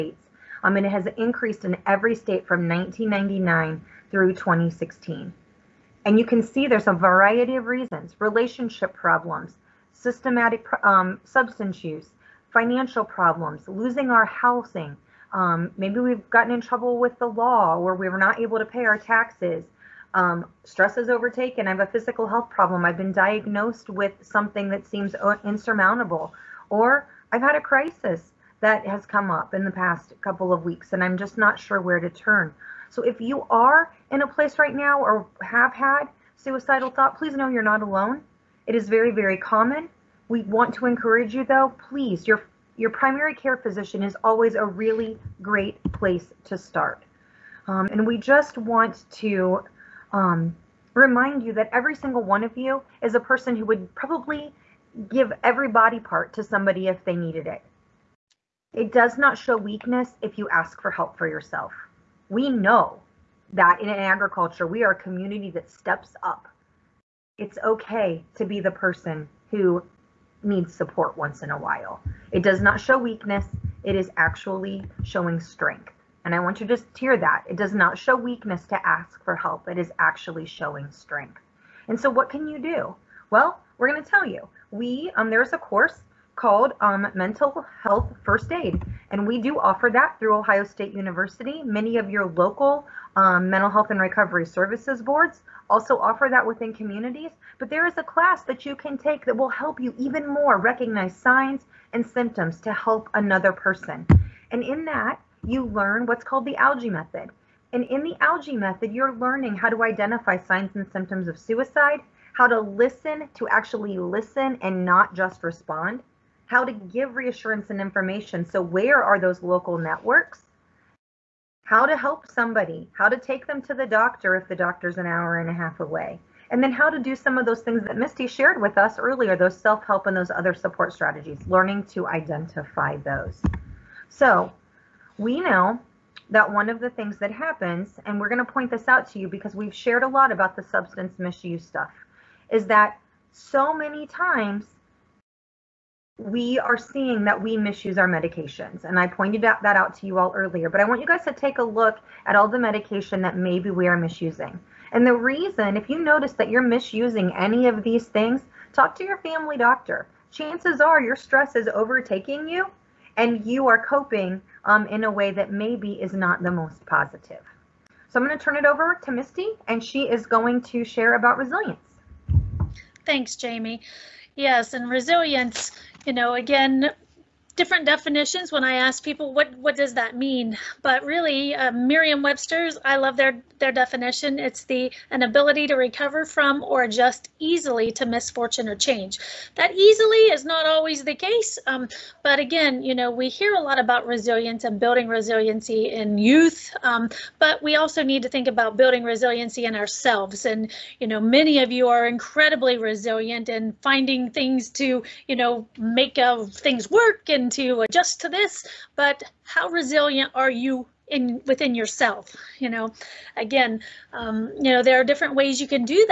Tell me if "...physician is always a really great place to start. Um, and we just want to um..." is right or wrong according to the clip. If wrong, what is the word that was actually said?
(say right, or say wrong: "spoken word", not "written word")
right.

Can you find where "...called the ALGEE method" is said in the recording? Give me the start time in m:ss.
1:46.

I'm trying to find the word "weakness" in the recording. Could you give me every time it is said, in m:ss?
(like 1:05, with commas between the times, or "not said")
0:59, 1:12, 1:18.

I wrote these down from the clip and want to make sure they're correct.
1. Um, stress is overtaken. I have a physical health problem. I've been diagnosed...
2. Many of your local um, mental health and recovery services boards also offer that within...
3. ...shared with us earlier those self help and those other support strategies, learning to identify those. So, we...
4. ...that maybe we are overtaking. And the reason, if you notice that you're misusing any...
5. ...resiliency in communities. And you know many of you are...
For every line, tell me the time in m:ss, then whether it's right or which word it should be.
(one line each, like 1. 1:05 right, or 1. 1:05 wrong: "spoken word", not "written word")
1. 0:20 right
2. 1:31 right
3. 2:08 right
4. 2:33 wrong: "misusing", not "overtaking"
5. 3:19 wrong: "ourselves", not "communities".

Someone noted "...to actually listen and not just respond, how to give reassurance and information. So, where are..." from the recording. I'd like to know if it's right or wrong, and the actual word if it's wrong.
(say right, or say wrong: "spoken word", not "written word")
right.